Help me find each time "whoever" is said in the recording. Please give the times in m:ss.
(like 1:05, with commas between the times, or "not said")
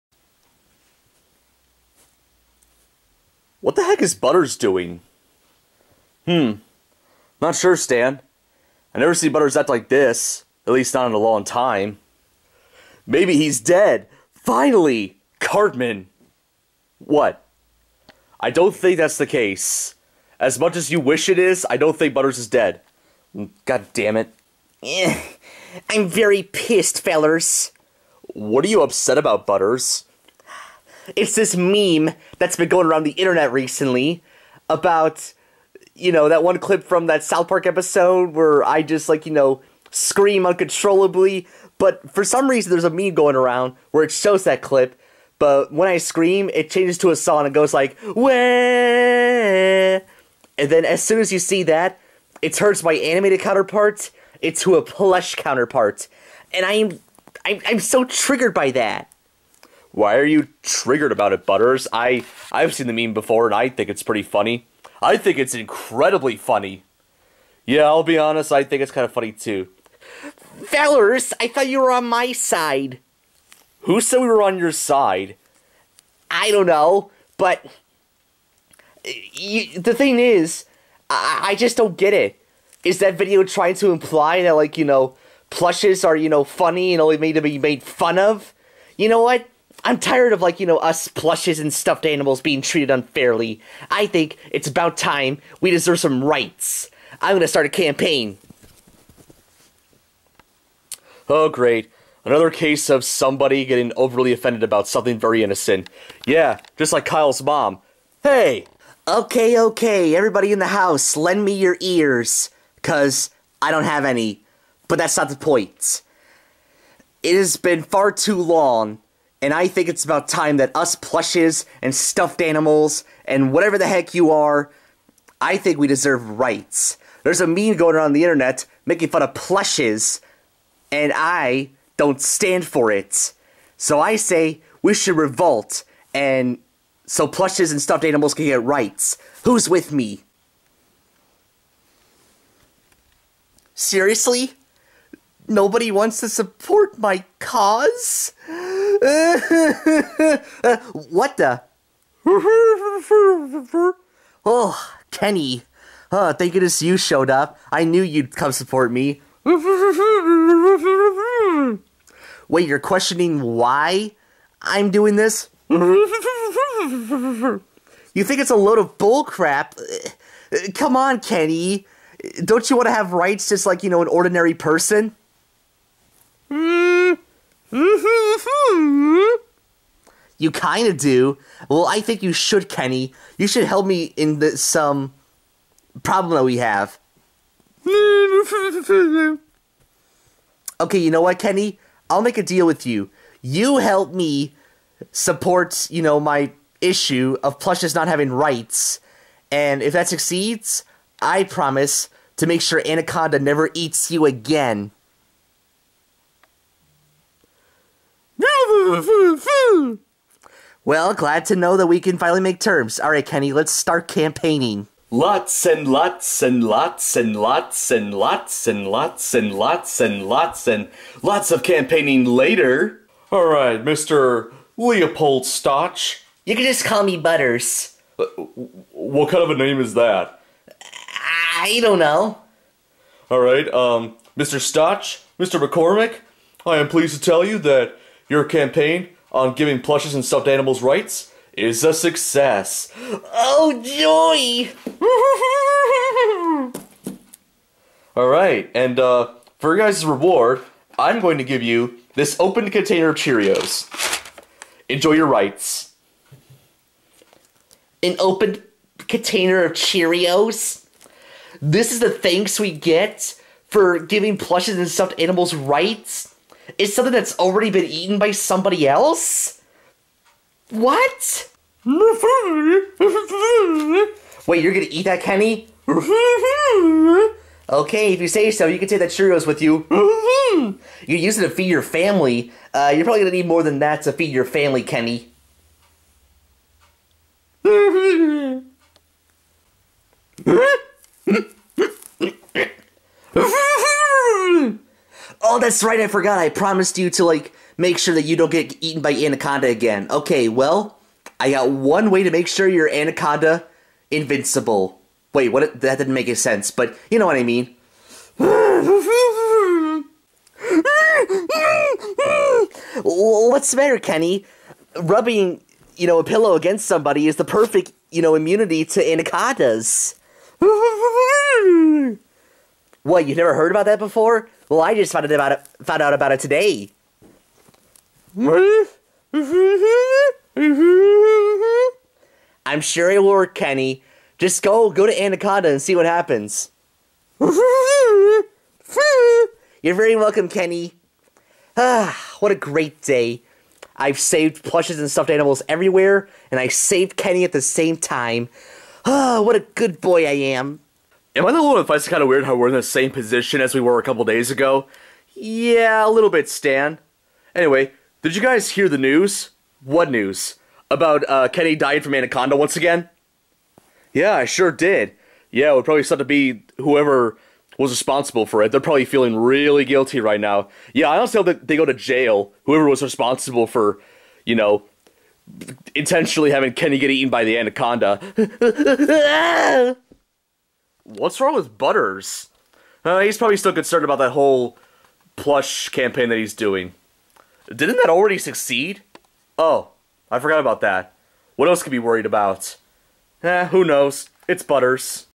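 6:06, 6:12.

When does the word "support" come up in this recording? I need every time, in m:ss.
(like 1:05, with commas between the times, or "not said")
2:26, 2:38, 3:15.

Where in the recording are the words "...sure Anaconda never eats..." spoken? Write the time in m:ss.
3:22.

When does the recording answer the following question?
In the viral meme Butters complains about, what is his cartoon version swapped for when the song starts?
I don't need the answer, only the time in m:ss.
0:54.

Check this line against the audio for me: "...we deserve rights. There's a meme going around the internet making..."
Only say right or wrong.
right.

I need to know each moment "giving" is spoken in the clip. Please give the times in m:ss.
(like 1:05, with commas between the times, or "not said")
3:59, 4:23.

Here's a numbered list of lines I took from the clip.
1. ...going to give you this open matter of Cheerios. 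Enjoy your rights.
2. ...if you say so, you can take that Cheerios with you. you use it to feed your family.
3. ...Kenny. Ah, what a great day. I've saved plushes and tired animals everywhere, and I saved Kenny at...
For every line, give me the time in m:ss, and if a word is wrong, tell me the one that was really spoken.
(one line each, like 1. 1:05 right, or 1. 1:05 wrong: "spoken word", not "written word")
1. 4:11 wrong: "container", not "matter"
2. 4:38 right
3. 5:40 wrong: "stuffed", not "tired".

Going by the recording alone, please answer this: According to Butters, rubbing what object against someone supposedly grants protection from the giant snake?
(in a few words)
A pillow.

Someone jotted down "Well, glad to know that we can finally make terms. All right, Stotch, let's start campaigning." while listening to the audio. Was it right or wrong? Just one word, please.
wrong.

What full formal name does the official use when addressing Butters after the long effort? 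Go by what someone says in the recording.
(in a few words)
Leopold Stotch.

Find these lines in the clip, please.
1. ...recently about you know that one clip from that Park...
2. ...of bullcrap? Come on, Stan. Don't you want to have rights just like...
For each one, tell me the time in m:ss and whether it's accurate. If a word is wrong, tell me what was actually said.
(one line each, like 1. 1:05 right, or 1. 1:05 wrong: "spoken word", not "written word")
1. 0:33 wrong: "South", not "Park"
2. 2:48 wrong: "Kenny", not "Stan".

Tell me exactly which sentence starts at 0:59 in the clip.
Why are you triggered about it, Butters?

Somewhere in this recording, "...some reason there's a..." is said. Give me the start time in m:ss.
0:42.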